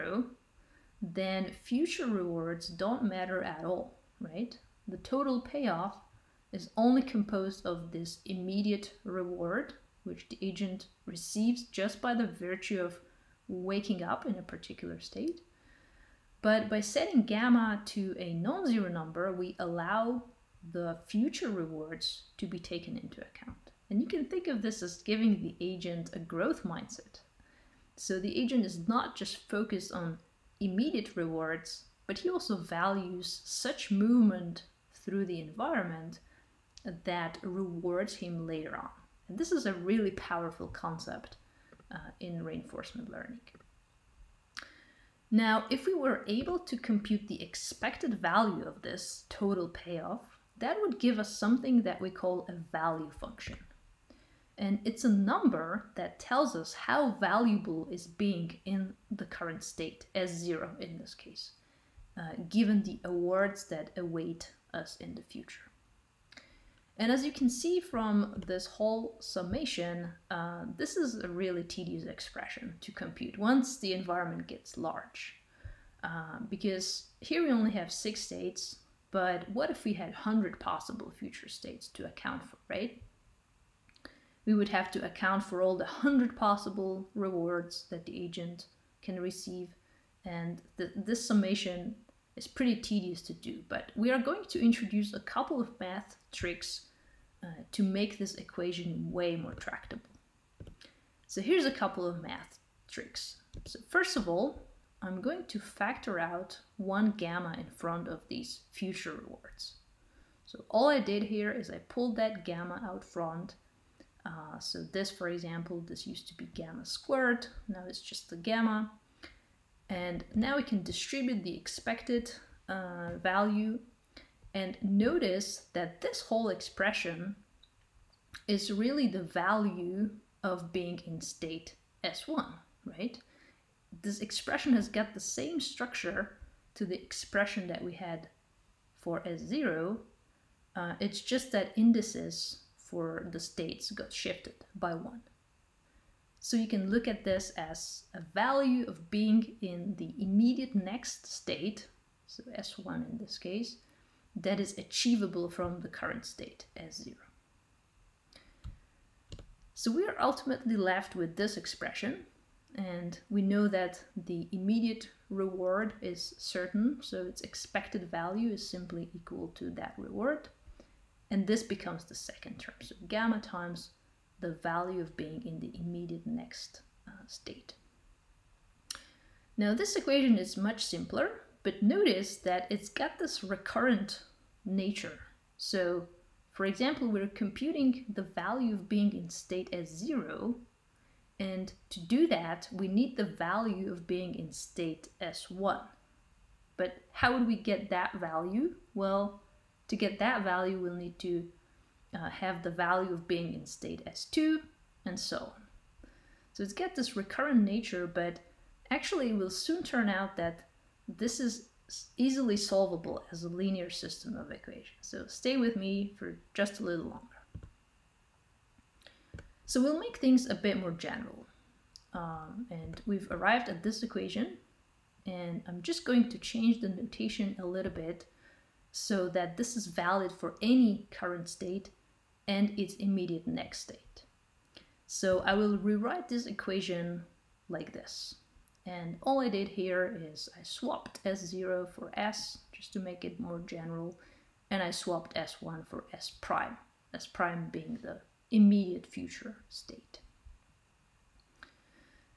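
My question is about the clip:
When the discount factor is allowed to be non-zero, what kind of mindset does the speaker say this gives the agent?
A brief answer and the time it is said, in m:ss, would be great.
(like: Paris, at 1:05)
growth mindset, at 0:26.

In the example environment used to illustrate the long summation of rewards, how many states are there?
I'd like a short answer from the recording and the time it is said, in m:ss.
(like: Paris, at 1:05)
6, at 1:17.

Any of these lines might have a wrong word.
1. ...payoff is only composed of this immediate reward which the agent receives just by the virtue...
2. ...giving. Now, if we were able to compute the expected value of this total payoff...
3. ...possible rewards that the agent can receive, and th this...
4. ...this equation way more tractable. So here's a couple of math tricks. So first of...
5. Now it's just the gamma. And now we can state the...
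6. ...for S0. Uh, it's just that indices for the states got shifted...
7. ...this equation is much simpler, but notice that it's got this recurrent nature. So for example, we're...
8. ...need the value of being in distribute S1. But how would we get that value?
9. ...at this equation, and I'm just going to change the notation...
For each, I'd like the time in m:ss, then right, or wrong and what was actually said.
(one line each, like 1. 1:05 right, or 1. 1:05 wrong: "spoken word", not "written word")
1. 0:05 right
2. 0:43 wrong: "learning", not "giving"
3. 1:26 right
4. 1:38 right
5. 1:57 wrong: "distribute", not "state"
6. 2:18 right
7. 2:59 right
8. 3:12 wrong: "state", not "distribute"
9. 3:43 right.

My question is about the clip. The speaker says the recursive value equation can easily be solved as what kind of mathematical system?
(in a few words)
linear system of equations.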